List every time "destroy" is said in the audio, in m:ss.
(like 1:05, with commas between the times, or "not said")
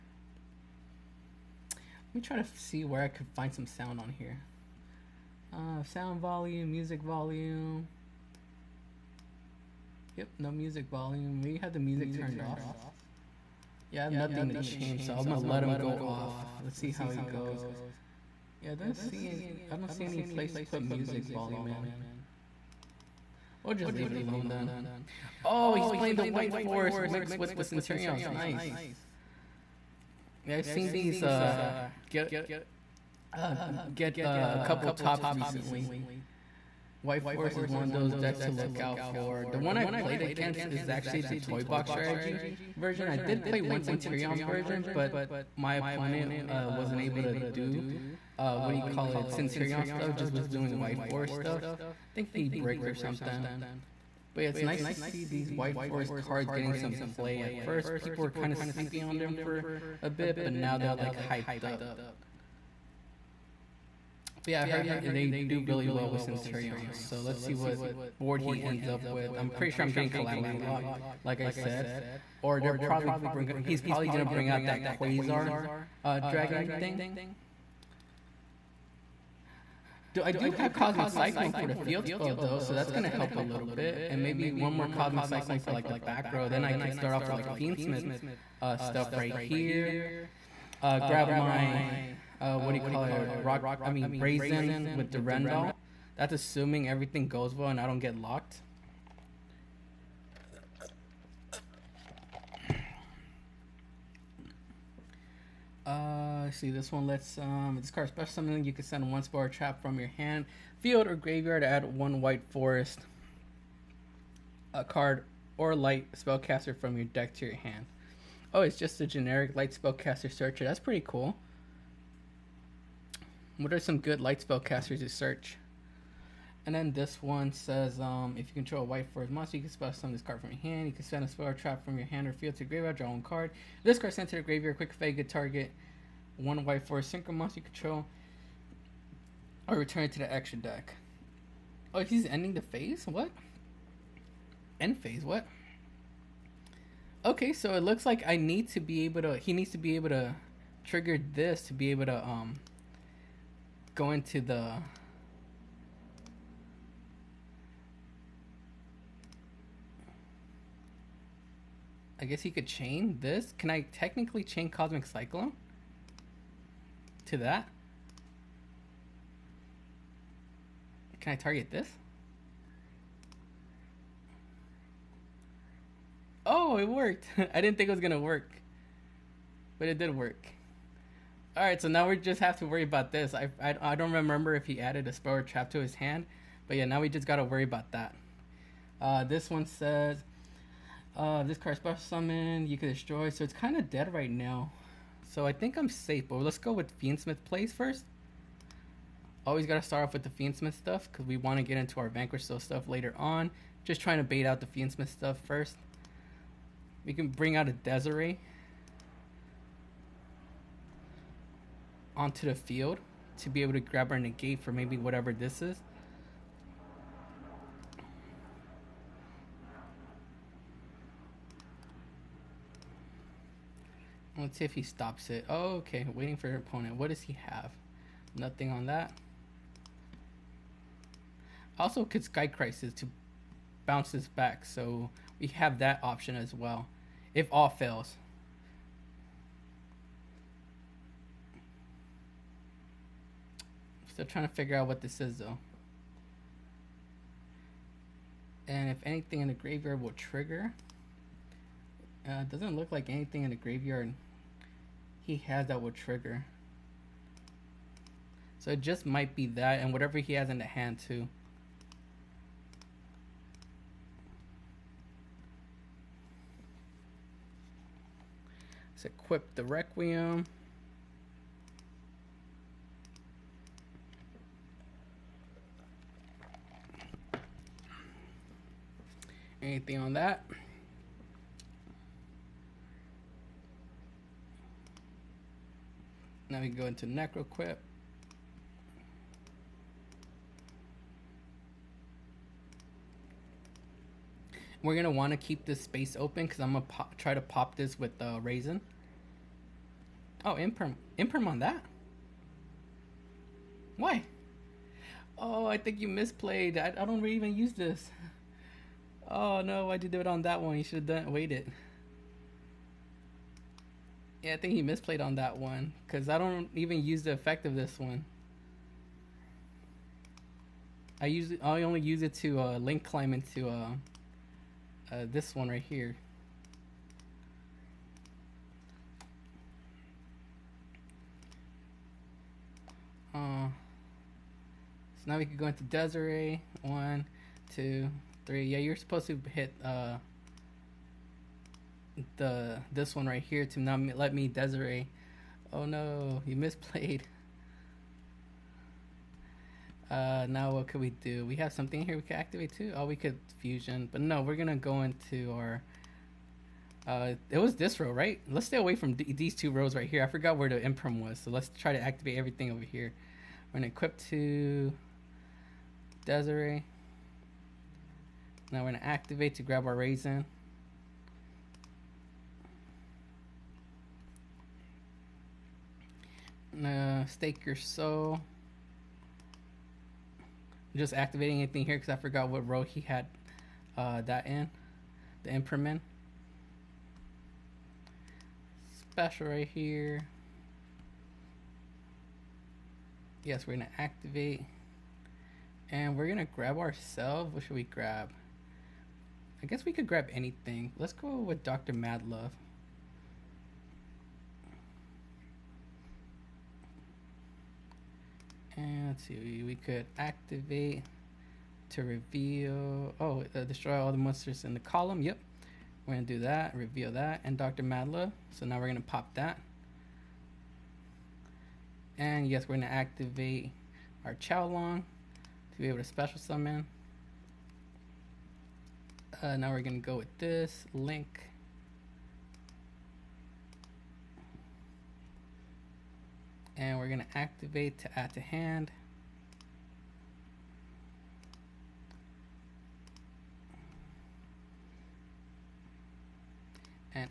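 3:12, 6:53.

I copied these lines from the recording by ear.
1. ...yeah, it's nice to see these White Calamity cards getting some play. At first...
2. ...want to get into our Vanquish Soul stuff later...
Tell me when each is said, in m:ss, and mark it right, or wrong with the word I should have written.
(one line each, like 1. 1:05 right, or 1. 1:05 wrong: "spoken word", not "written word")
1. 0:54 wrong: "Forest", not "Calamity"
2. 3:21 right.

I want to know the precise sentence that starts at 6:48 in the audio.
And let's see, we, we could activate to reveal.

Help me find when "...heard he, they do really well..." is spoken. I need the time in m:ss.
1:04.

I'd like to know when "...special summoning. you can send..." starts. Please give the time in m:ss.
1:48.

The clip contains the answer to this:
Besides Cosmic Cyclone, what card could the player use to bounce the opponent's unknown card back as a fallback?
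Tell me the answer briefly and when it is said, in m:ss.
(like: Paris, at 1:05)
Sky Crisis, at 3:52.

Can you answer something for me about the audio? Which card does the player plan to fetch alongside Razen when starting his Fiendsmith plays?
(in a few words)
Rendall.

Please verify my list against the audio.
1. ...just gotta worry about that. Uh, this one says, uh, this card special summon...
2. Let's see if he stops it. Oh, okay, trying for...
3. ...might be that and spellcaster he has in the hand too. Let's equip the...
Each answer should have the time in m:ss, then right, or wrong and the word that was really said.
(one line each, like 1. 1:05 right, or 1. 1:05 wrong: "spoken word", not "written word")
1. 3:07 right
2. 3:44 wrong: "waiting", not "trying"
3. 4:19 wrong: "whatever", not "spellcaster".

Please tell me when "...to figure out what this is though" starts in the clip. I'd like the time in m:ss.
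4:04.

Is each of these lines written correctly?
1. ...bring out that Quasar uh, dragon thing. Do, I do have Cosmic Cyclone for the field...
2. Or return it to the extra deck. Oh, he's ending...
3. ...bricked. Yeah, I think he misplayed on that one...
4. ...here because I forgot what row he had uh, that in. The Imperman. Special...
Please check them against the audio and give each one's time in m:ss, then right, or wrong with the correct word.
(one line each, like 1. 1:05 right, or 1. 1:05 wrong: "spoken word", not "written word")
1. 1:14 right
2. 2:19 right
3. 5:11 wrong: "waited", not "bricked"
4. 6:21 right.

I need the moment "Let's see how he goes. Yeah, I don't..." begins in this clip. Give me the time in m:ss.
0:16.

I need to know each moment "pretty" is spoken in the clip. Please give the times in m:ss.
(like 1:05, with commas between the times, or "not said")
1:09, 2:00.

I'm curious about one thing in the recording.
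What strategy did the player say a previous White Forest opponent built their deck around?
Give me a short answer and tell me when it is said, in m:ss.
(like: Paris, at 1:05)
Toy Box, at 0:41.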